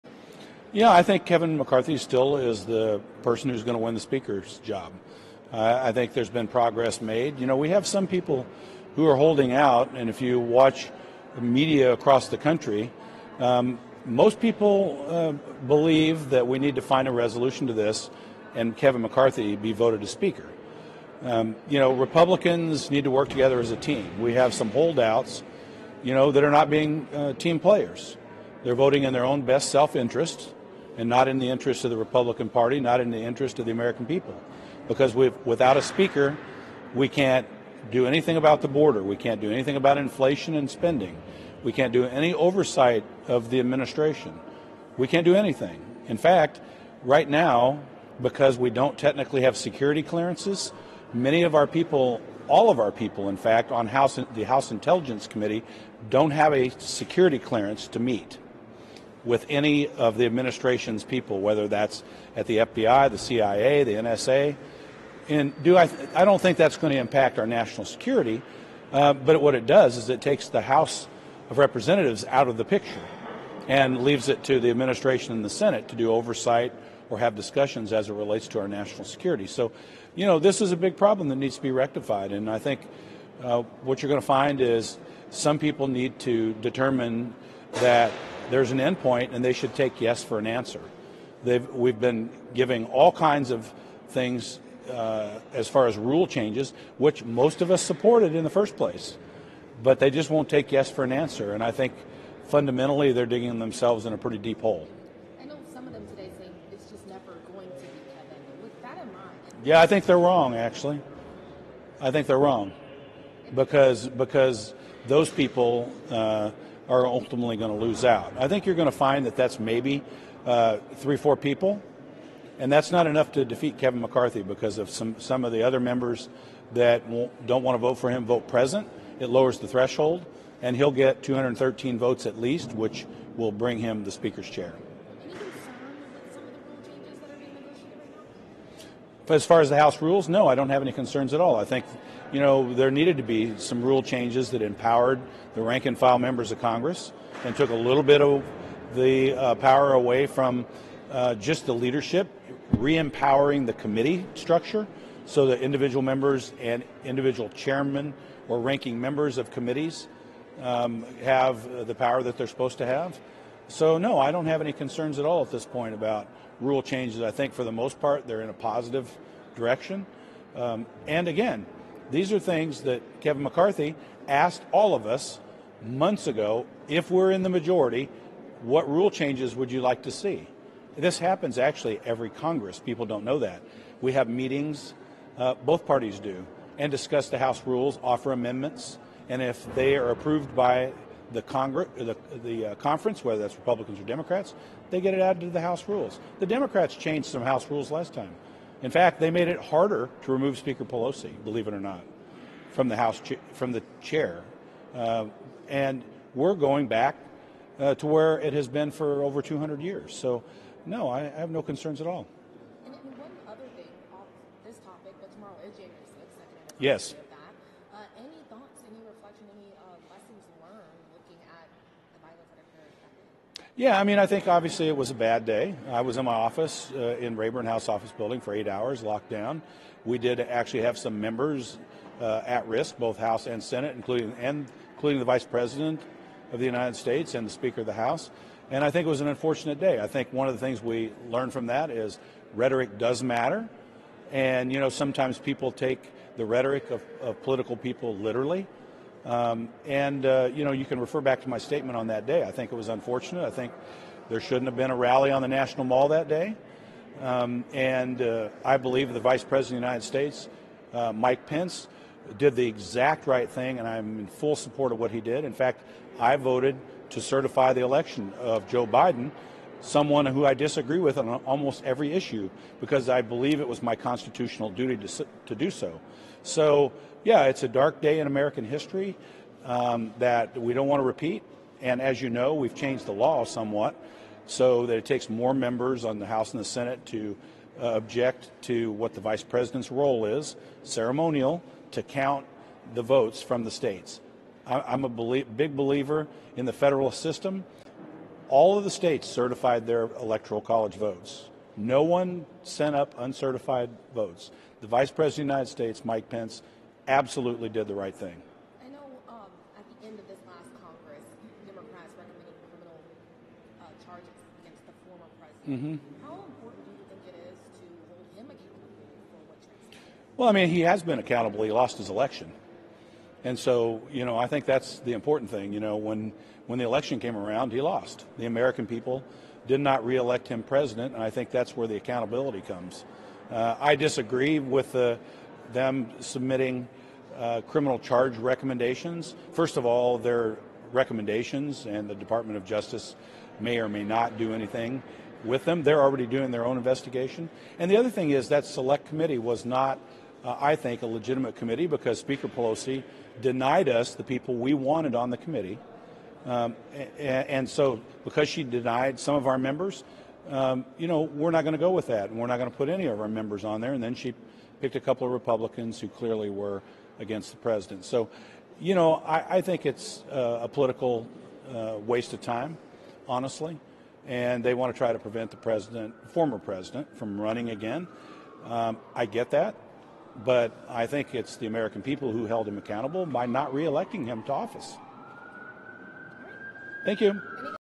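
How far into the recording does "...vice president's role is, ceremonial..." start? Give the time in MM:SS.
04:49.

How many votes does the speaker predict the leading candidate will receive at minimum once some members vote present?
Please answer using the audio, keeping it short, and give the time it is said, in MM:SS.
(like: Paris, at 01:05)
213, at 02:11.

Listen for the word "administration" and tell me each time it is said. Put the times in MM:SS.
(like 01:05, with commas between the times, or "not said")
00:43, 01:00, 01:14.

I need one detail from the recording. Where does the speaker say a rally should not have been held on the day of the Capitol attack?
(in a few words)
National Mall.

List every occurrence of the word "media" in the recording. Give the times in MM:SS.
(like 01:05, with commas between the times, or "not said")
00:11.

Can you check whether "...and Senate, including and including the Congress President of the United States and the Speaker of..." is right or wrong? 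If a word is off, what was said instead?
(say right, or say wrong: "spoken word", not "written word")
wrong: "Vice", not "Congress".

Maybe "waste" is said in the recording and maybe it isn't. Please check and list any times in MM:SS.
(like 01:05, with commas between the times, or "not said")
06:12.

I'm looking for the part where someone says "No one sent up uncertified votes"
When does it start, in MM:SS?
05:01.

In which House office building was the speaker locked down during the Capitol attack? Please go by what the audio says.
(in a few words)
Rayburn.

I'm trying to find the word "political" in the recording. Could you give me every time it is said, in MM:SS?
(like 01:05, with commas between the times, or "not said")
04:07, 06:10.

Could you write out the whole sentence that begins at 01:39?
But they just won't take yes for an answer.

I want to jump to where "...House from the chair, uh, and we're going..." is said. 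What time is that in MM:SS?
03:22.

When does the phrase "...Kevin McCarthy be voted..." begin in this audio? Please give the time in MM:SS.
00:18.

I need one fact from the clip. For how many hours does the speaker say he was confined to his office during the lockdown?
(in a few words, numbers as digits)
8.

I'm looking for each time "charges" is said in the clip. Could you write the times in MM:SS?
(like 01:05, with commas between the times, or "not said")
05:14, 05:37.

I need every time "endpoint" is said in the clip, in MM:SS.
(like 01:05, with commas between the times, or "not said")
01:28.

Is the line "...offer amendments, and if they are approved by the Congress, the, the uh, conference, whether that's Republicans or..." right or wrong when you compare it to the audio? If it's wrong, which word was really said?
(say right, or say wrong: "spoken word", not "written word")
right.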